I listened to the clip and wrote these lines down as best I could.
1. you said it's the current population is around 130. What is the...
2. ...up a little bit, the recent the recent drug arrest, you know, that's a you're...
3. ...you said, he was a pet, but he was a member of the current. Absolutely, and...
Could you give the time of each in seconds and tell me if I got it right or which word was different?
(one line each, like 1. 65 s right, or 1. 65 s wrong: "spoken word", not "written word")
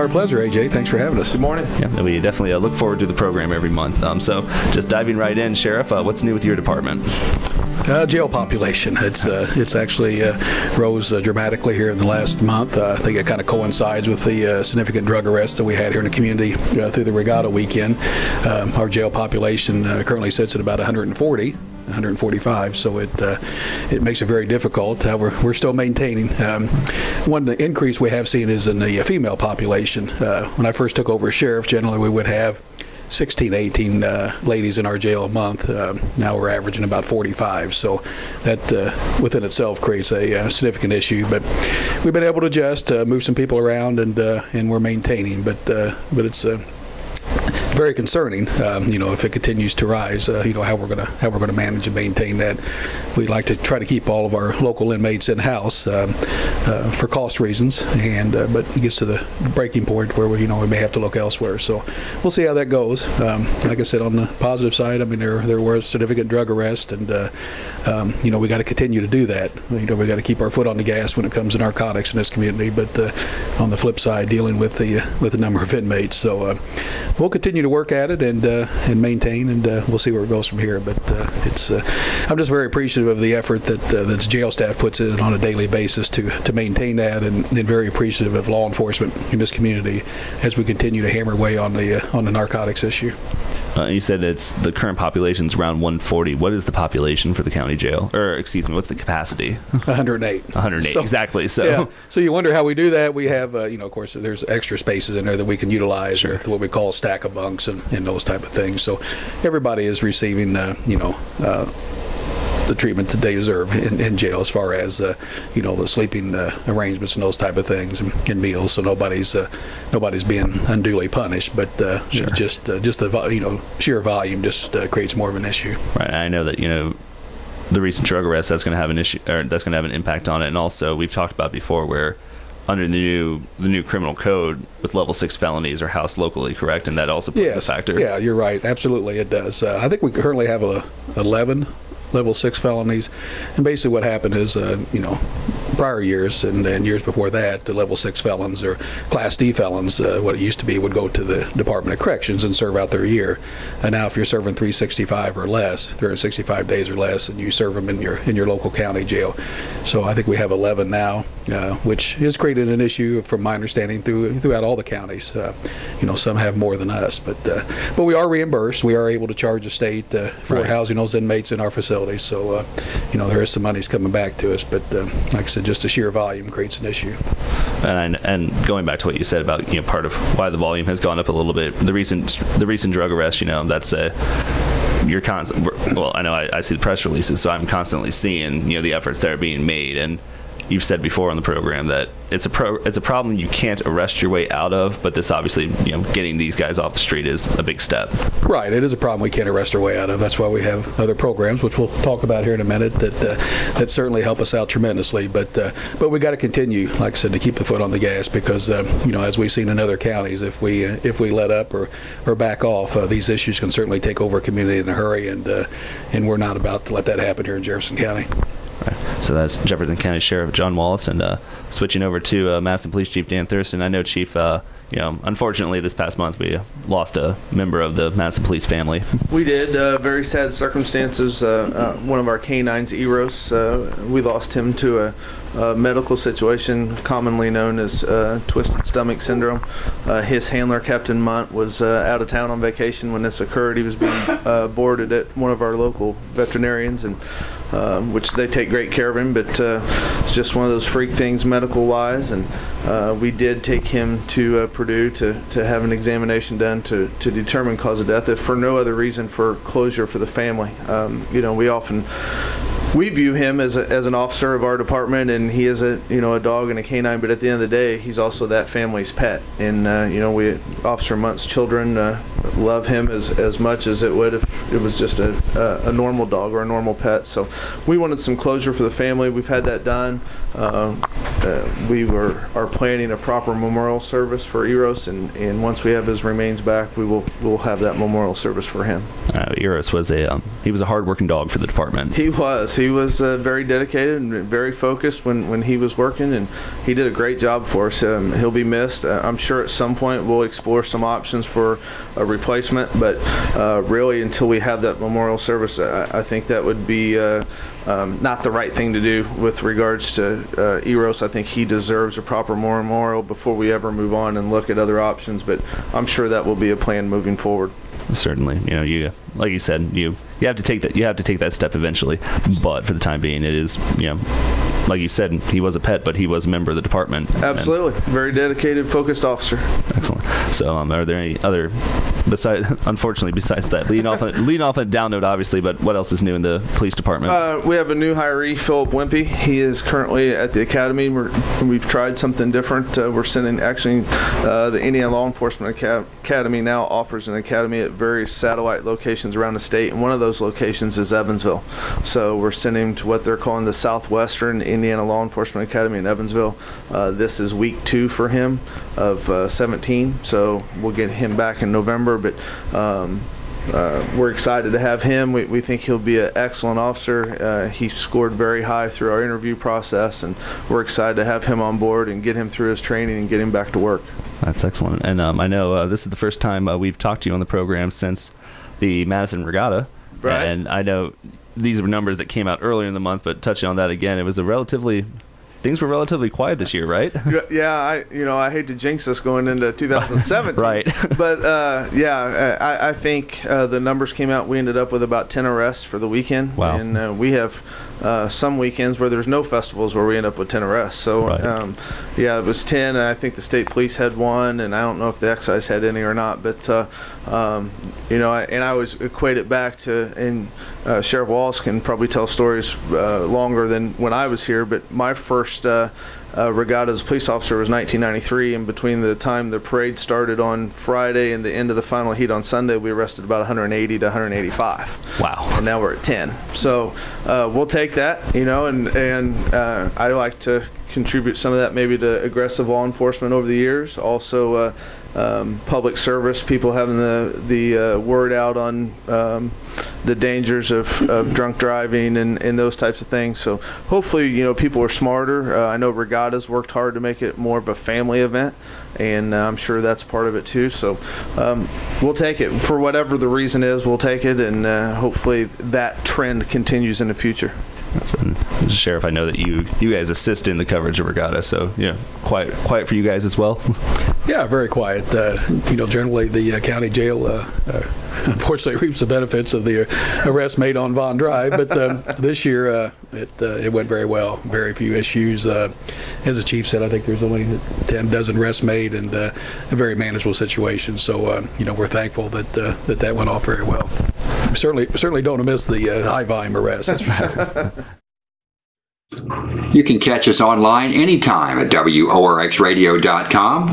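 1. 93 s wrong: "140", not "130"
2. 181 s right
3. 325 s wrong: "department", not "current".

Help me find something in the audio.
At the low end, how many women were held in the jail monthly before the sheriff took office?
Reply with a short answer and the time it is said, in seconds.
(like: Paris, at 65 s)
16, at 33 s.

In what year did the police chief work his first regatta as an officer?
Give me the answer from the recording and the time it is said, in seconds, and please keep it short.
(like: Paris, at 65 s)
1993, at 417 s.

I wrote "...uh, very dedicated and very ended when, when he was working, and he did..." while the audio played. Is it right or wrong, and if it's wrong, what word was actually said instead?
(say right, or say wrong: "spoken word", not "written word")
wrong: "focused", not "ended".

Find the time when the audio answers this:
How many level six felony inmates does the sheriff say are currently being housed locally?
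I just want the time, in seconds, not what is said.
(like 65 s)
141 s.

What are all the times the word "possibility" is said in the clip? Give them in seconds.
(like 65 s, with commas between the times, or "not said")
not said.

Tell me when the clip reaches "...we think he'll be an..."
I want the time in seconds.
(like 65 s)
365 s.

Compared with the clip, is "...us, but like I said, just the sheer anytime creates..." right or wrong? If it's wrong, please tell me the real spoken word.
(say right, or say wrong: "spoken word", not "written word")
wrong: "volume", not "anytime".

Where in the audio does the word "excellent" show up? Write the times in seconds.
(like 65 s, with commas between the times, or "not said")
329 s, 366 s, 374 s.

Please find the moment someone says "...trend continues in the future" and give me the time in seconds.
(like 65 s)
456 s.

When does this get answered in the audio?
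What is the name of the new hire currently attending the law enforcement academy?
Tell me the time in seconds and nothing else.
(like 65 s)
338 s.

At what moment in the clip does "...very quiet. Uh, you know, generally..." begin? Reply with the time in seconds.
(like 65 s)
464 s.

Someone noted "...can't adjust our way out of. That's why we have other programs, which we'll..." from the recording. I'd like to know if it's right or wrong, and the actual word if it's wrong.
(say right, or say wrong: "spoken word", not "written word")
wrong: "arrest", not "adjust".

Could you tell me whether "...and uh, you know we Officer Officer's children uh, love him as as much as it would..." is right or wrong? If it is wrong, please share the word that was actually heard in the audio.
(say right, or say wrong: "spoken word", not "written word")
wrong: "Munt", not "Officer".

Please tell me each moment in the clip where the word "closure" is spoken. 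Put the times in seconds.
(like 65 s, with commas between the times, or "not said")
259 s, 278 s.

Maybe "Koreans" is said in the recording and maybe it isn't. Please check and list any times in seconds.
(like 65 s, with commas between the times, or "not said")
not said.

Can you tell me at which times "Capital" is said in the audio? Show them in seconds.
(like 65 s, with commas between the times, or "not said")
not said.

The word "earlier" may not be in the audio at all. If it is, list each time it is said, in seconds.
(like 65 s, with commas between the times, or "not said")
382 s.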